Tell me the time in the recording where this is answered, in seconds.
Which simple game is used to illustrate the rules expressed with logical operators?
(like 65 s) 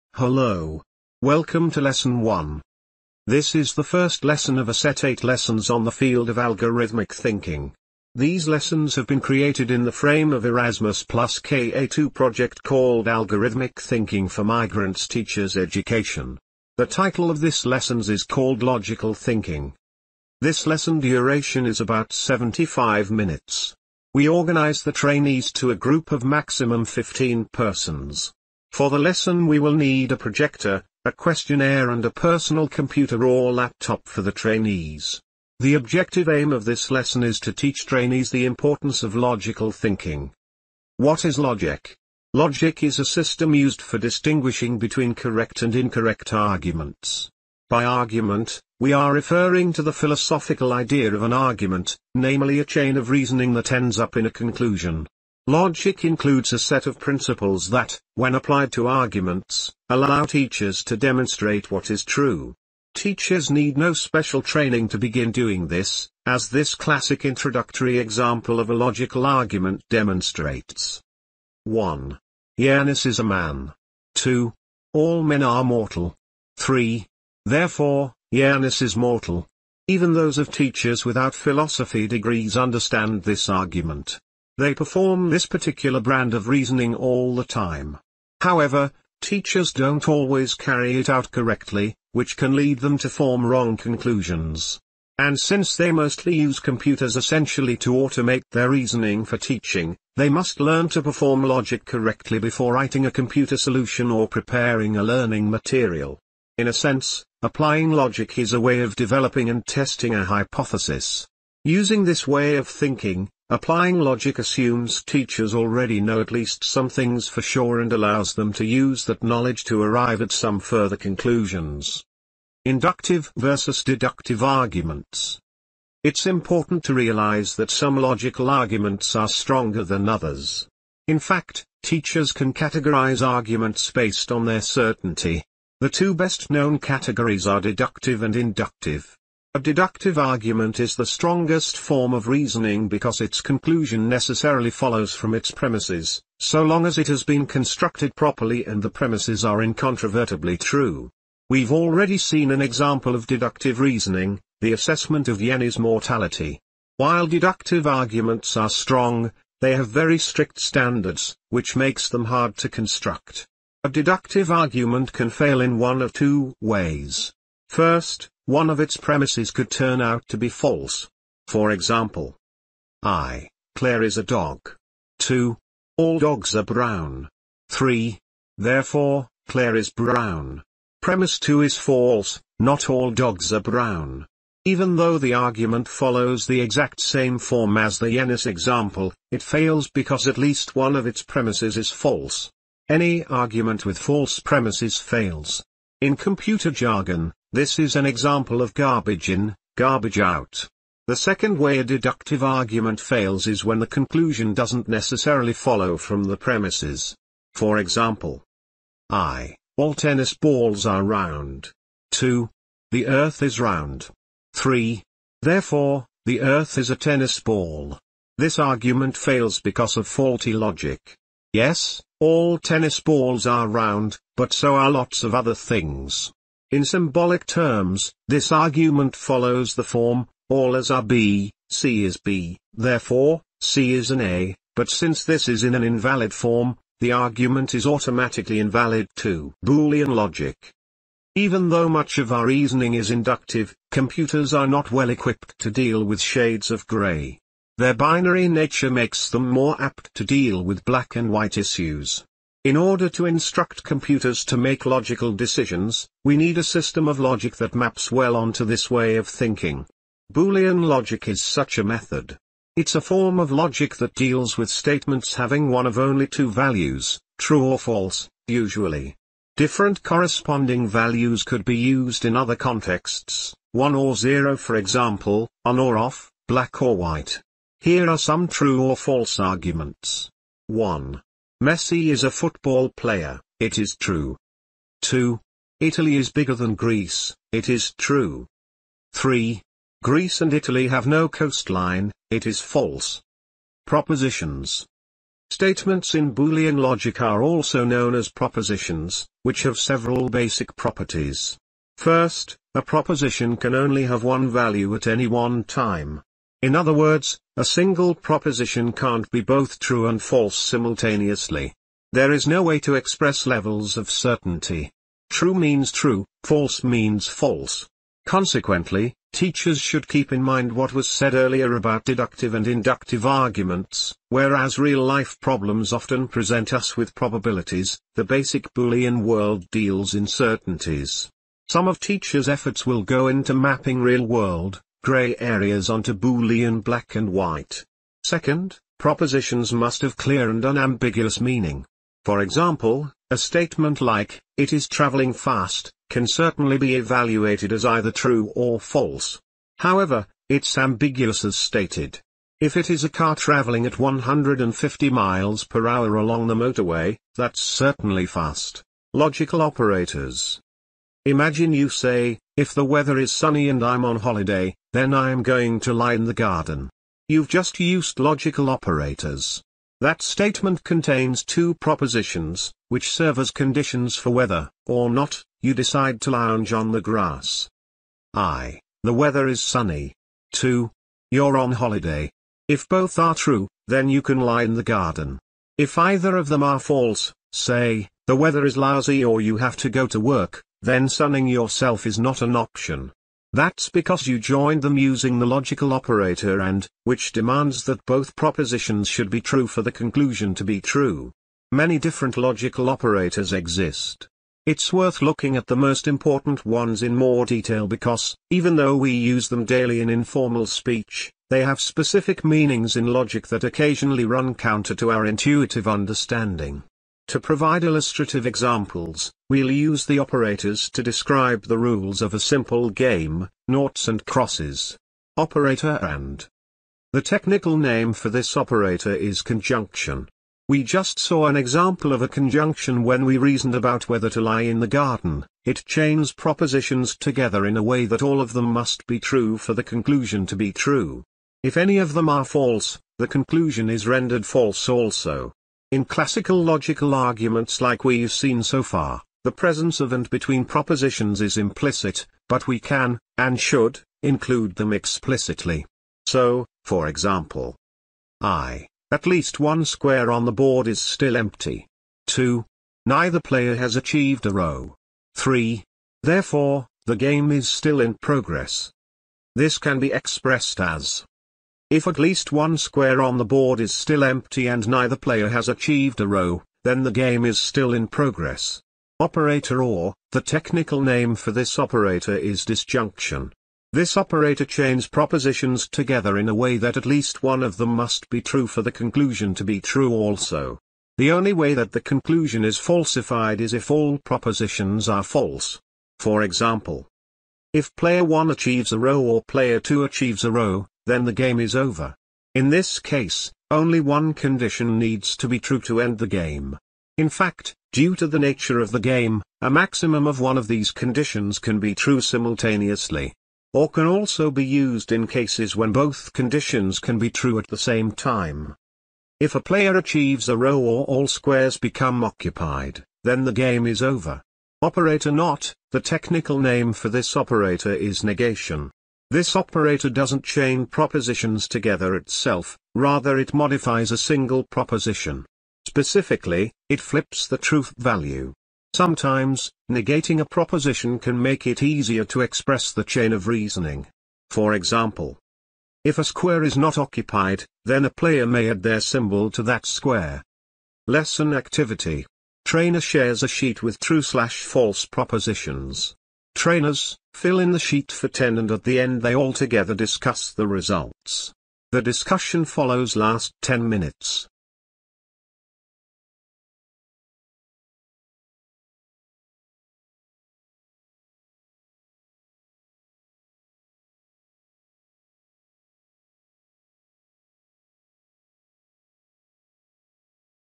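423 s.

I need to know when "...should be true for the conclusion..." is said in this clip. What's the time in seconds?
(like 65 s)
399 s.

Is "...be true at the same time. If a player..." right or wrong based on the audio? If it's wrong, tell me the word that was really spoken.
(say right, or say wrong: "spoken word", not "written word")
right.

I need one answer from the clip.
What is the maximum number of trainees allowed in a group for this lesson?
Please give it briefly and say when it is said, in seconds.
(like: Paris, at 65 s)
15, at 26 s.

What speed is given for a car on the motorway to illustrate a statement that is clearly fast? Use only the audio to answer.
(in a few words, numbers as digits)
150 miles per hour.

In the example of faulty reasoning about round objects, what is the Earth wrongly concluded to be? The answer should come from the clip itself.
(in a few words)
a tennis ball.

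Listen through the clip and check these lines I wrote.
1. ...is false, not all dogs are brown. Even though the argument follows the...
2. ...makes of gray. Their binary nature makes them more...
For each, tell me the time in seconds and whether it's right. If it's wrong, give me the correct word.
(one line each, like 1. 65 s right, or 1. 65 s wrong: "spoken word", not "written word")
1. 181 s right
2. 246 s wrong: "shades", not "makes".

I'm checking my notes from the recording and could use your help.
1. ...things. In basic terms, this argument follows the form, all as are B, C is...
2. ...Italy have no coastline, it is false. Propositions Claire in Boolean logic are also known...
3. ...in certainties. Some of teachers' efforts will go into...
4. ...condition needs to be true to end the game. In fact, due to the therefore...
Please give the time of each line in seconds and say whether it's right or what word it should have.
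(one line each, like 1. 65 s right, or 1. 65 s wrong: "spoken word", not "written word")
1. 225 s wrong: "symbolic", not "basic"
2. 290 s wrong: "Statements", not "Claire"
3. 330 s right
4. 504 s wrong: "nature", not "therefore".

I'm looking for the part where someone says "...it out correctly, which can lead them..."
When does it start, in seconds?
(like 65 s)
90 s.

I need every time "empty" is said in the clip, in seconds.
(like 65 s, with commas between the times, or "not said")
461 s, 474 s.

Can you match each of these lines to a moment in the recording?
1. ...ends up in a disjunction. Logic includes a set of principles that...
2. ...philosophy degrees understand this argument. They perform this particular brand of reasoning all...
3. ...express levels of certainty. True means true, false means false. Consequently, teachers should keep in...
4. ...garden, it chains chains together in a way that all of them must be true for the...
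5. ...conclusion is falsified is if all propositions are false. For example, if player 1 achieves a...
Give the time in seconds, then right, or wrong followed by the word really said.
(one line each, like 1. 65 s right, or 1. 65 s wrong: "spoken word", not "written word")
1. 53 s wrong: "conclusion", not "disjunction"
2. 81 s right
3. 312 s right
4. 434 s wrong: "propositions", not "chains"
5. 491 s right.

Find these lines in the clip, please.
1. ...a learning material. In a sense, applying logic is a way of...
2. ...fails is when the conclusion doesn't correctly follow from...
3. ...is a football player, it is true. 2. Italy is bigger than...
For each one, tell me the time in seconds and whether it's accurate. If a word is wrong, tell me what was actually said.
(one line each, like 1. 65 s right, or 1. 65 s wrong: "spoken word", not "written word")
1. 104 s right
2. 203 s wrong: "necessarily", not "correctly"
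3. 282 s right.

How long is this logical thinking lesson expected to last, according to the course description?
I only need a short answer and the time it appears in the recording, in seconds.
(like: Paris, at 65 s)
75 minutes, at 22 s.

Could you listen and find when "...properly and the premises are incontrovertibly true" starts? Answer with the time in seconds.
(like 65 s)
148 s.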